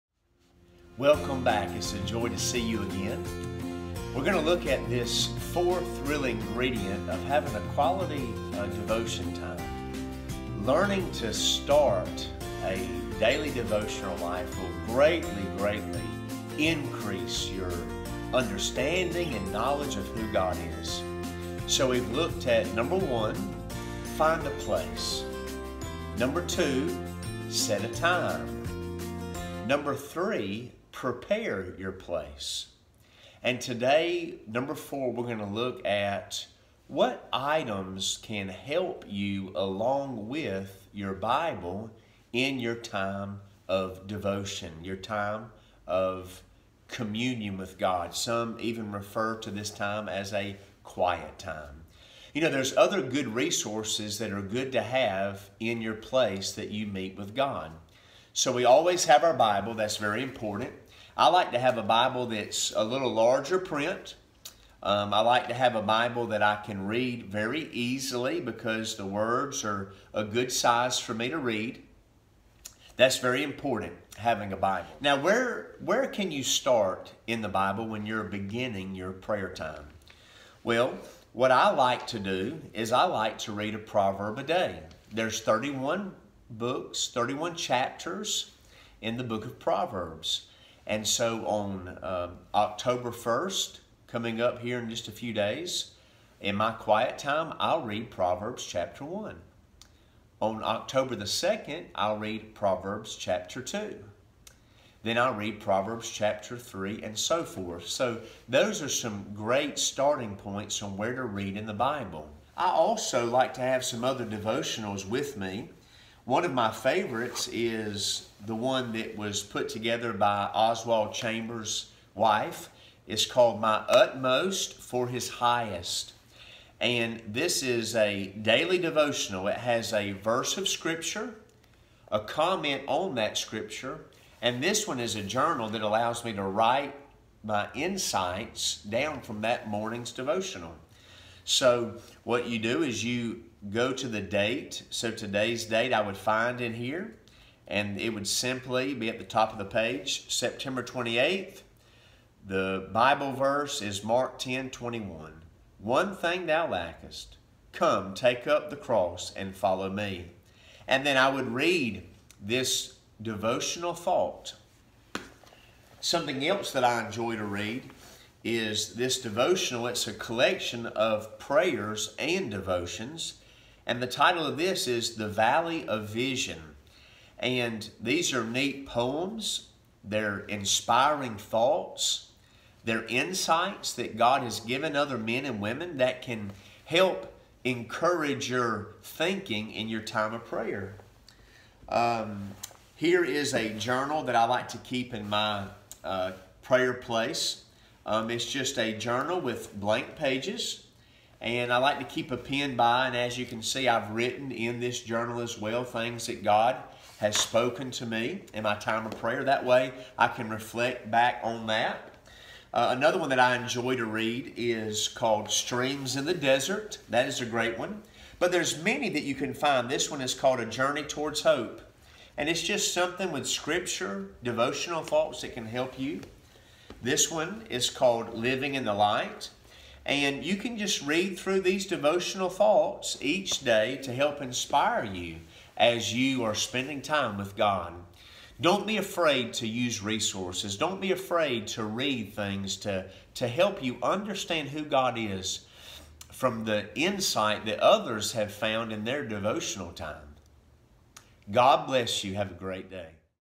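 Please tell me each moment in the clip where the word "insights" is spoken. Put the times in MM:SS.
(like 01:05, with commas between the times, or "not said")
02:17, 03:03, 04:06.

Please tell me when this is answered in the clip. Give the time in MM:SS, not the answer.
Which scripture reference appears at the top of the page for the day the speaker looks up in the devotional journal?
02:34.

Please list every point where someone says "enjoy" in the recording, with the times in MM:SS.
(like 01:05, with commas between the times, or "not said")
02:47, 03:33.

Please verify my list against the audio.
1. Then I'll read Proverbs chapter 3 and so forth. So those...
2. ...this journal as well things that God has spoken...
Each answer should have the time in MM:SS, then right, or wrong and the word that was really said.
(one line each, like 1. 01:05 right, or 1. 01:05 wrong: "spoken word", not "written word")
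1. 01:45 right
2. 03:24 right.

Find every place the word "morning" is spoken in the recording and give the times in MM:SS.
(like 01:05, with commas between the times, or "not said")
02:19.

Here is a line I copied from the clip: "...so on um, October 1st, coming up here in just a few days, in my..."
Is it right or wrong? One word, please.
right.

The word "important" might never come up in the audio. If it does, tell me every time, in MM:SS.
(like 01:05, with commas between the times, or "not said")
01:00, 01:13.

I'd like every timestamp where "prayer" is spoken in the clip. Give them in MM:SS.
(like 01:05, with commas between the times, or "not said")
01:19, 02:51, 03:10, 03:16, 03:29.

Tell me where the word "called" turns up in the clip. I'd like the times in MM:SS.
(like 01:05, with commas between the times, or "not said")
02:03, 03:35, 03:40, 03:47.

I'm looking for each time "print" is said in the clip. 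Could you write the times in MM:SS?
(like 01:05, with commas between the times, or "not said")
01:03.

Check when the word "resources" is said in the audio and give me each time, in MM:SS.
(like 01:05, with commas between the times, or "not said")
00:53, 04:00.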